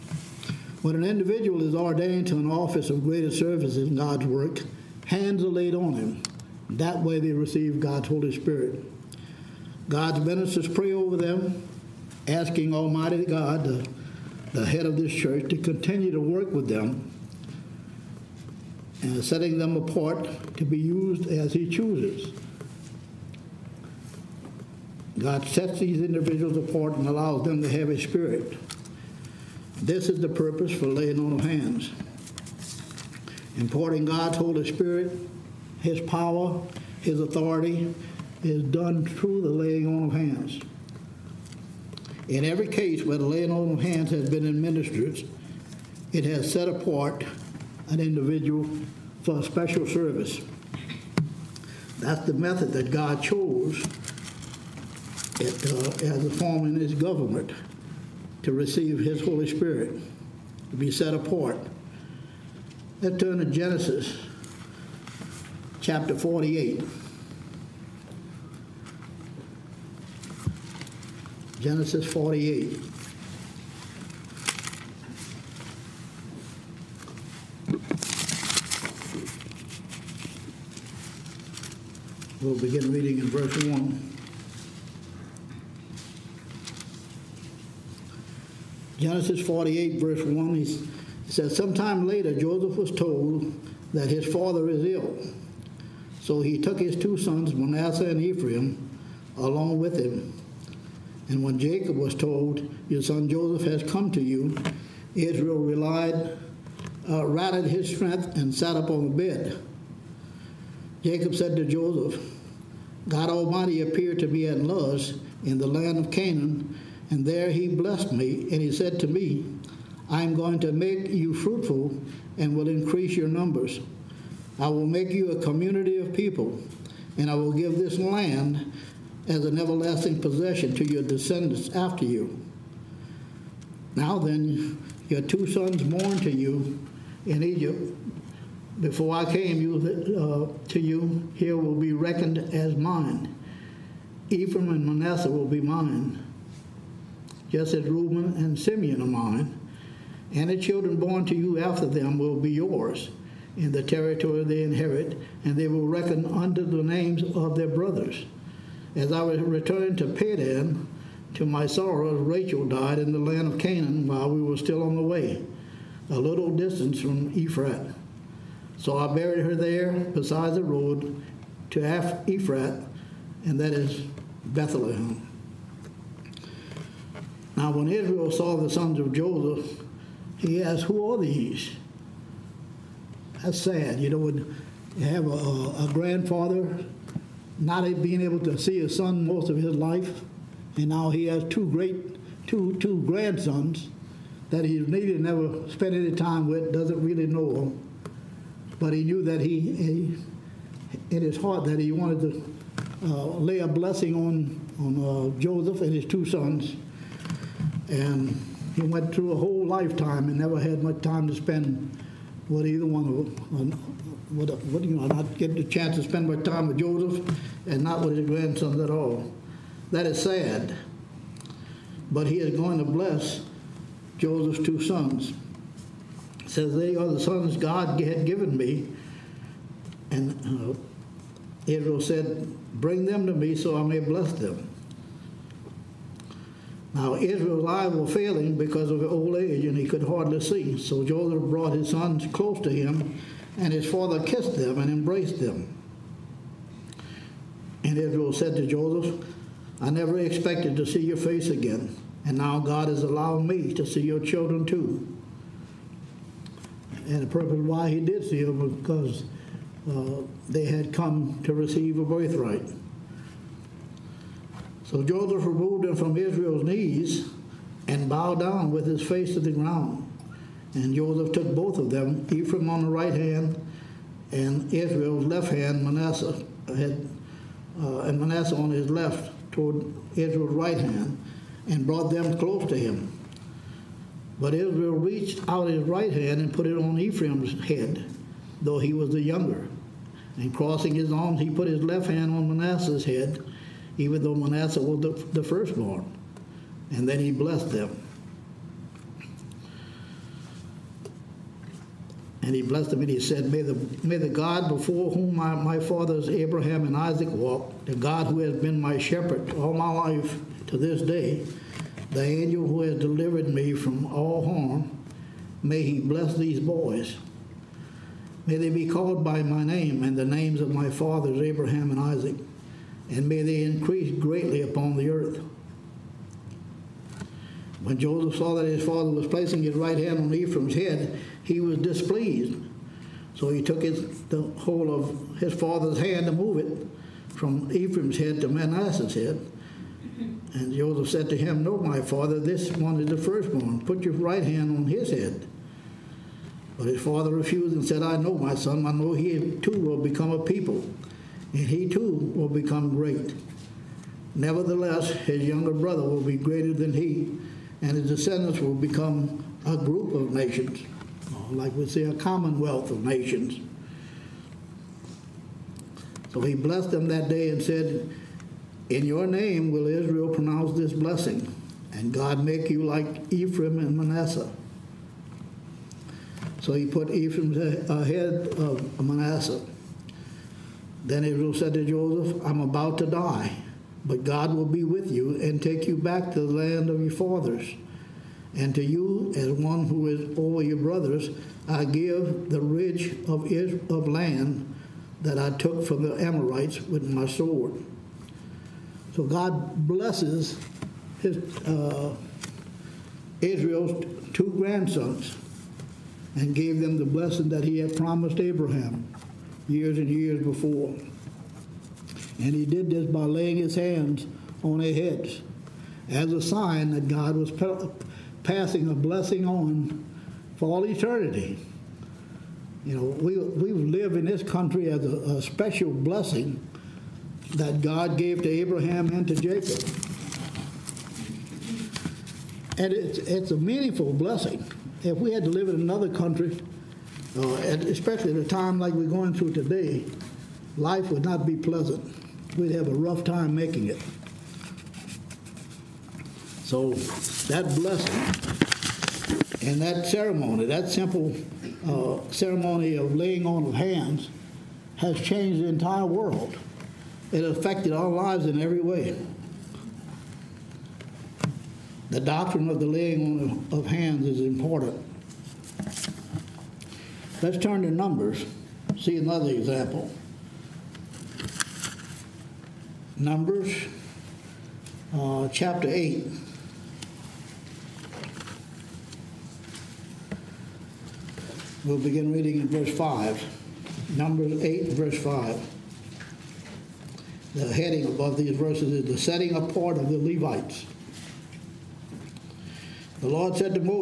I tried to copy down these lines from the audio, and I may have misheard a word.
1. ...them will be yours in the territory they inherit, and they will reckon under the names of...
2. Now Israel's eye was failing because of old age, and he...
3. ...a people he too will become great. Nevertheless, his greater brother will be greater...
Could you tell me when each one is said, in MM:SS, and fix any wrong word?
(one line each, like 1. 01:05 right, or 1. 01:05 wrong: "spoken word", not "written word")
1. 02:31 right
2. 03:56 right
3. 05:50 wrong: "younger", not "greater".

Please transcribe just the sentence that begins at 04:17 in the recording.
And the purpose why he did see them was because uh, they had come to receive a birthright.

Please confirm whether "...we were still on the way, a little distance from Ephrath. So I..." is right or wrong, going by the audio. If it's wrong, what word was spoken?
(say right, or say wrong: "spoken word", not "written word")
right.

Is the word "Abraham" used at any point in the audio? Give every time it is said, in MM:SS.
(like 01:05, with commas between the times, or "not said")
05:06, 05:21, 06:48, 07:08.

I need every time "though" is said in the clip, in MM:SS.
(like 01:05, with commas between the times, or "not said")
04:48, 04:54.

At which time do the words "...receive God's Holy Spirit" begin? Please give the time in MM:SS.
00:07.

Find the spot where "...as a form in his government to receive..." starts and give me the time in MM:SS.
00:56.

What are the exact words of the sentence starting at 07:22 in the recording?
We'd have a rough time making it.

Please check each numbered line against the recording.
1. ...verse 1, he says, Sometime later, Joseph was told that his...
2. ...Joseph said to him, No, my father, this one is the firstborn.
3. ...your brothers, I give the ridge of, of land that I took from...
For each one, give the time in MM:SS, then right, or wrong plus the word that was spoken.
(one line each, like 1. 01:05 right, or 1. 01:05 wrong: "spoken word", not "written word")
1. 01:29 right
2. 05:40 right
3. 06:30 right.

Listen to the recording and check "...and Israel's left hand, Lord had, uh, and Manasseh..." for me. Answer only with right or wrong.
wrong.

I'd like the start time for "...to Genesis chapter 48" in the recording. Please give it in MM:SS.
01:03.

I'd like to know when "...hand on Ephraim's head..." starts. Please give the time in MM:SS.
05:29.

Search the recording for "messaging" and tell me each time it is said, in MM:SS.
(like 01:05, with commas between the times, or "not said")
not said.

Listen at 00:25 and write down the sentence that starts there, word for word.
God sets these individuals apart and allows them to have a spirit.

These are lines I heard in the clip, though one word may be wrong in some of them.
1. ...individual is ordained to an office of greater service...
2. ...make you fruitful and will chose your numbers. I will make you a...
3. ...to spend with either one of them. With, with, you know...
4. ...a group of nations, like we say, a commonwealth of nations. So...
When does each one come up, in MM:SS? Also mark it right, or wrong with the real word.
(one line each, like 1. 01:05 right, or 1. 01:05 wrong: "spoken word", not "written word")
1. 00:01 right
2. 02:00 wrong: "increase", not "chose"
3. 03:31 right
4. 05:59 right.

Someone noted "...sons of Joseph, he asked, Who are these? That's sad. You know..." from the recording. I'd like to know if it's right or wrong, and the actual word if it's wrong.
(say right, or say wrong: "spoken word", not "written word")
right.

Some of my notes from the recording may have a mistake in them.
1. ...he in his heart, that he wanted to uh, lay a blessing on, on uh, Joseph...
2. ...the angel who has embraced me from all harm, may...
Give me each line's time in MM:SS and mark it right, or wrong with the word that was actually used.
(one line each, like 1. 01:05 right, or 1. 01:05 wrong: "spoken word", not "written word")
1. 03:19 right
2. 05:12 wrong: "delivered", not "embraced".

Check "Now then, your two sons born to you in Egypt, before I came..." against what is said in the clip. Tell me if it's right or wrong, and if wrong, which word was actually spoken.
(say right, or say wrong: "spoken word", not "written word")
right.